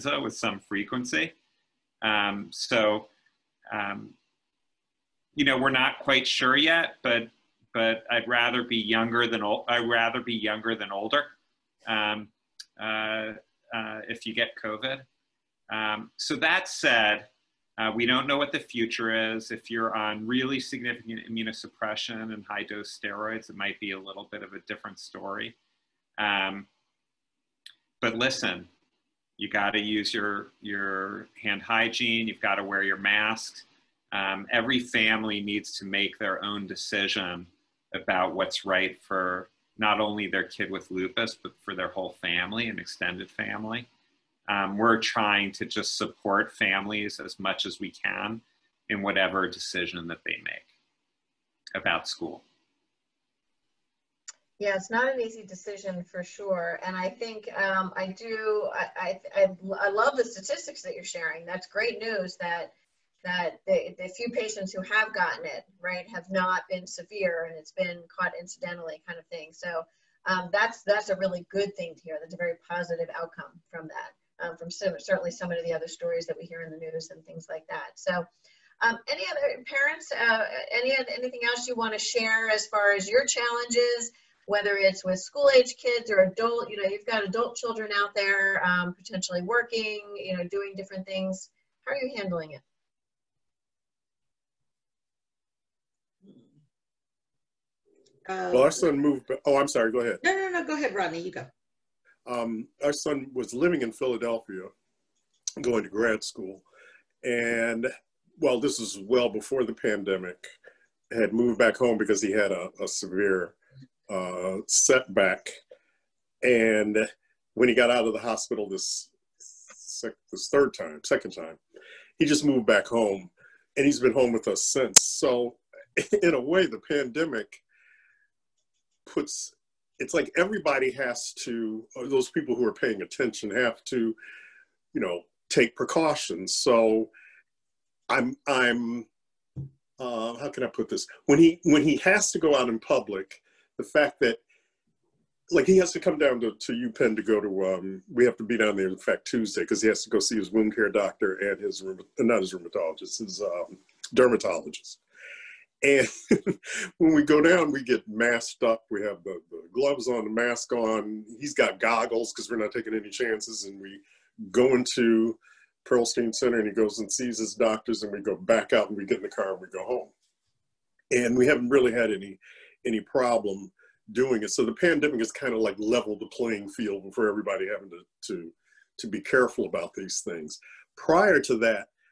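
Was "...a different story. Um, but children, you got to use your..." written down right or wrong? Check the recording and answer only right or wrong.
wrong.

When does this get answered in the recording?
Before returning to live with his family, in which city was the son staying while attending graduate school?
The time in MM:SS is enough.
01:43.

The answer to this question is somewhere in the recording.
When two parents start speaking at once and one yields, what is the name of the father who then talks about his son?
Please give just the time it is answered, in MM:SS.
01:40.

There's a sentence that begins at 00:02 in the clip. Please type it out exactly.
Um, so, um, you know, we're not quite sure yet, but but I'd rather be younger than old.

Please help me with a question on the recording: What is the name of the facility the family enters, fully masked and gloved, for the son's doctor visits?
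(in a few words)
Pearlstein Center.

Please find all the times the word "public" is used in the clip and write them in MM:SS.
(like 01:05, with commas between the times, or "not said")
02:22.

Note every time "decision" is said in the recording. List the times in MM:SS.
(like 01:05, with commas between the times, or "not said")
00:36, 00:49, 00:55.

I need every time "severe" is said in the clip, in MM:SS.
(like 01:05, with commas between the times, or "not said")
01:06, 01:52.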